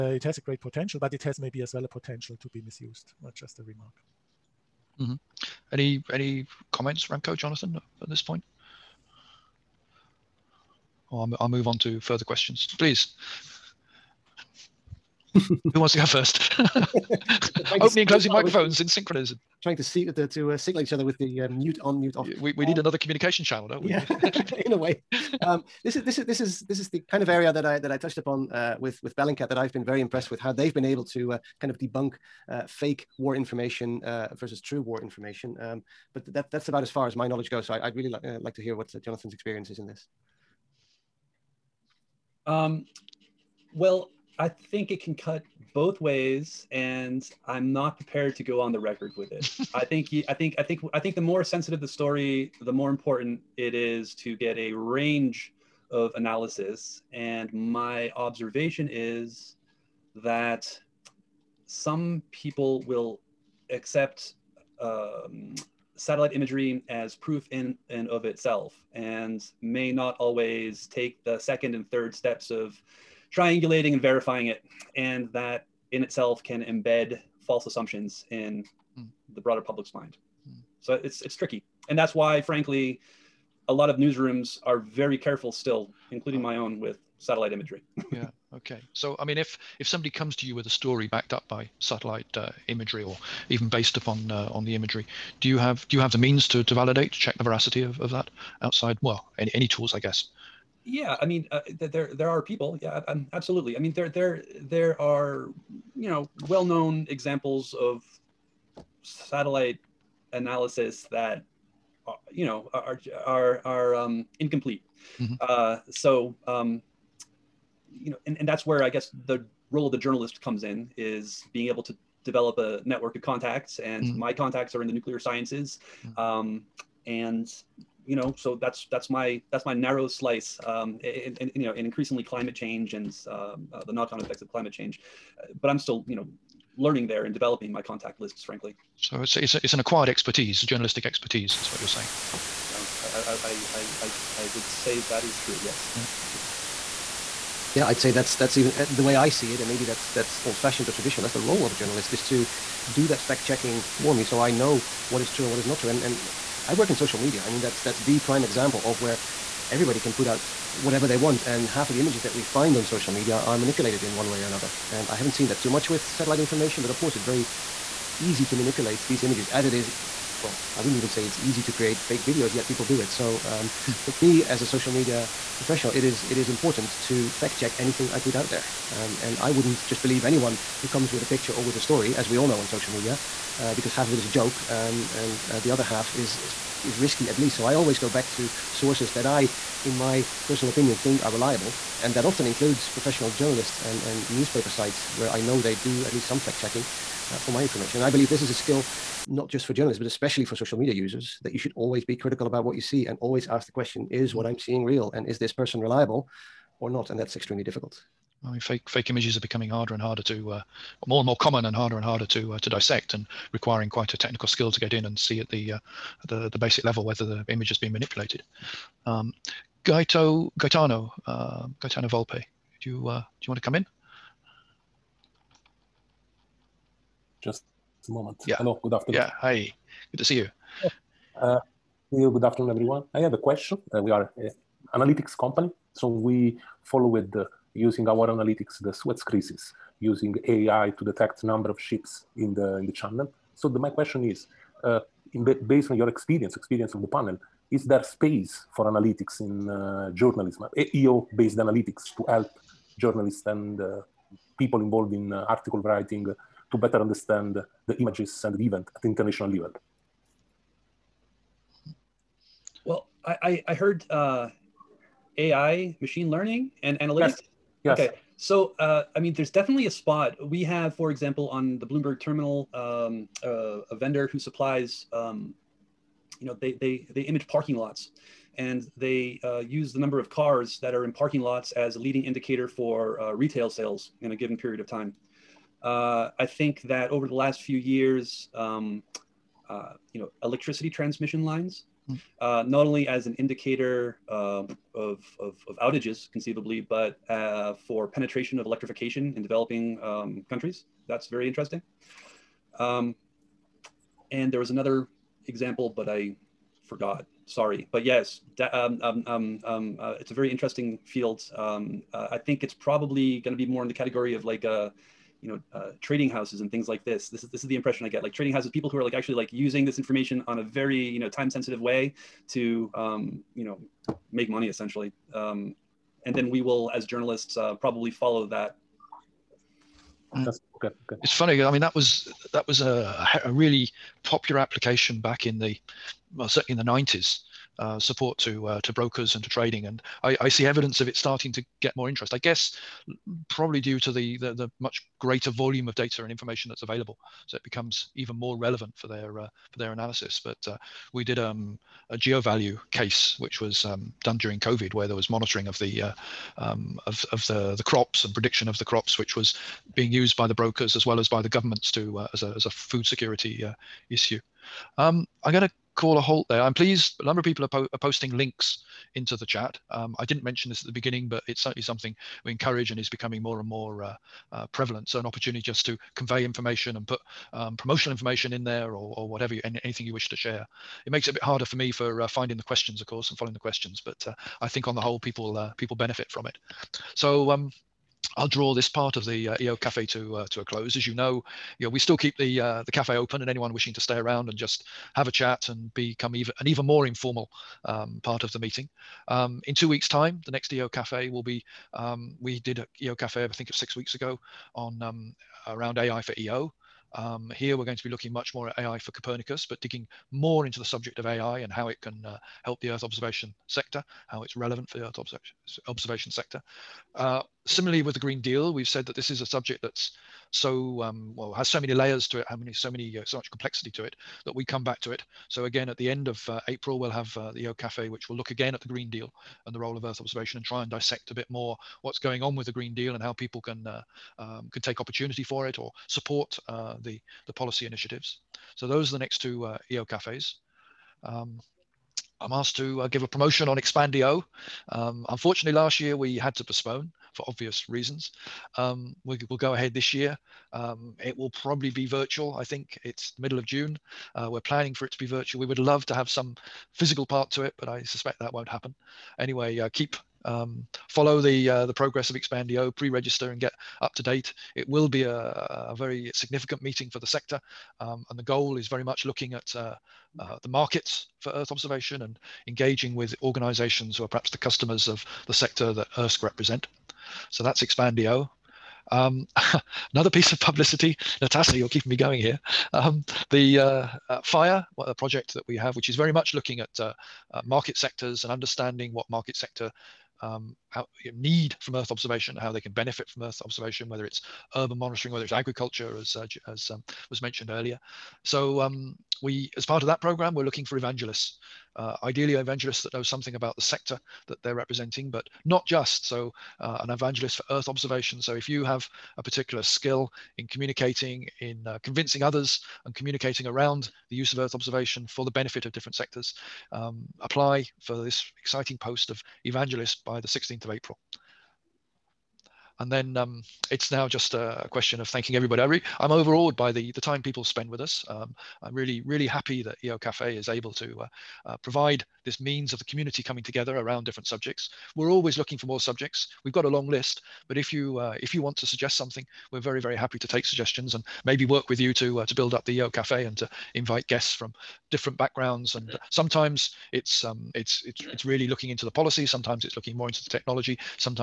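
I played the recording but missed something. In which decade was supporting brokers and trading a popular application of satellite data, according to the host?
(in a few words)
1990s.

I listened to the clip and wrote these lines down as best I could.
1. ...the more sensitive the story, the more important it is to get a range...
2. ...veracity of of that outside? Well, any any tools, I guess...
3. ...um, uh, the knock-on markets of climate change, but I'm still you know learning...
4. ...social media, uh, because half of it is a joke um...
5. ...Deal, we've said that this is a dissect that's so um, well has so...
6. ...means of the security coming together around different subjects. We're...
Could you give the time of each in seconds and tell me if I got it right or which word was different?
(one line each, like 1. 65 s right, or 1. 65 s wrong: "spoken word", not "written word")
1. 51 s right
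2. 97 s right
3. 133 s wrong: "effects", not "markets"
4. 182 s right
5. 418 s wrong: "subject", not "dissect"
6. 532 s wrong: "community", not "security".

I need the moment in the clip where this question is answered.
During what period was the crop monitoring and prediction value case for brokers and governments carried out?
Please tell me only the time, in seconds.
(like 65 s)
354 s.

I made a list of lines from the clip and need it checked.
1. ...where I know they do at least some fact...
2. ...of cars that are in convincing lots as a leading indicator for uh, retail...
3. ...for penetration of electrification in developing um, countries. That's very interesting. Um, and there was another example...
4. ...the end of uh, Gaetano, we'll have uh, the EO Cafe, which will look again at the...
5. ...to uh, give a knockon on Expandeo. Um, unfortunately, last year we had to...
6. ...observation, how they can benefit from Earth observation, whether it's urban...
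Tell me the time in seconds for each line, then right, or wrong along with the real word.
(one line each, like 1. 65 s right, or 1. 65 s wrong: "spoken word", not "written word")
1. 195 s right
2. 280 s wrong: "parking", not "convincing"
3. 297 s right
4. 425 s wrong: "April", not "Gaetano"
5. 442 s wrong: "promotion", not "knockon"
6. 492 s right.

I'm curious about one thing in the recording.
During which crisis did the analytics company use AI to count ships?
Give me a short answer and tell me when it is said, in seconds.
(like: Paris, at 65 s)
Suez crisis, at 238 s.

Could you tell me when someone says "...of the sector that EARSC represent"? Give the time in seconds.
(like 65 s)
475 s.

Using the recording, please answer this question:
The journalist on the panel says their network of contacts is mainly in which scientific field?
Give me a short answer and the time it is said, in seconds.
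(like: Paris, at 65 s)
Nuclear sciences, at 124 s.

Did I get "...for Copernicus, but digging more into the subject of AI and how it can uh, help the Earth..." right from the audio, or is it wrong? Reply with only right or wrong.
right.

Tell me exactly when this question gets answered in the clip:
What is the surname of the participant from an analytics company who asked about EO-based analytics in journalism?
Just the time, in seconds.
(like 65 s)
222 s.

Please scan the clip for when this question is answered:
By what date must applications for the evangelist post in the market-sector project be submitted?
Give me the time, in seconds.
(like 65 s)
520 s.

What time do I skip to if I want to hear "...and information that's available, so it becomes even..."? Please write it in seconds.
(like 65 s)
346 s.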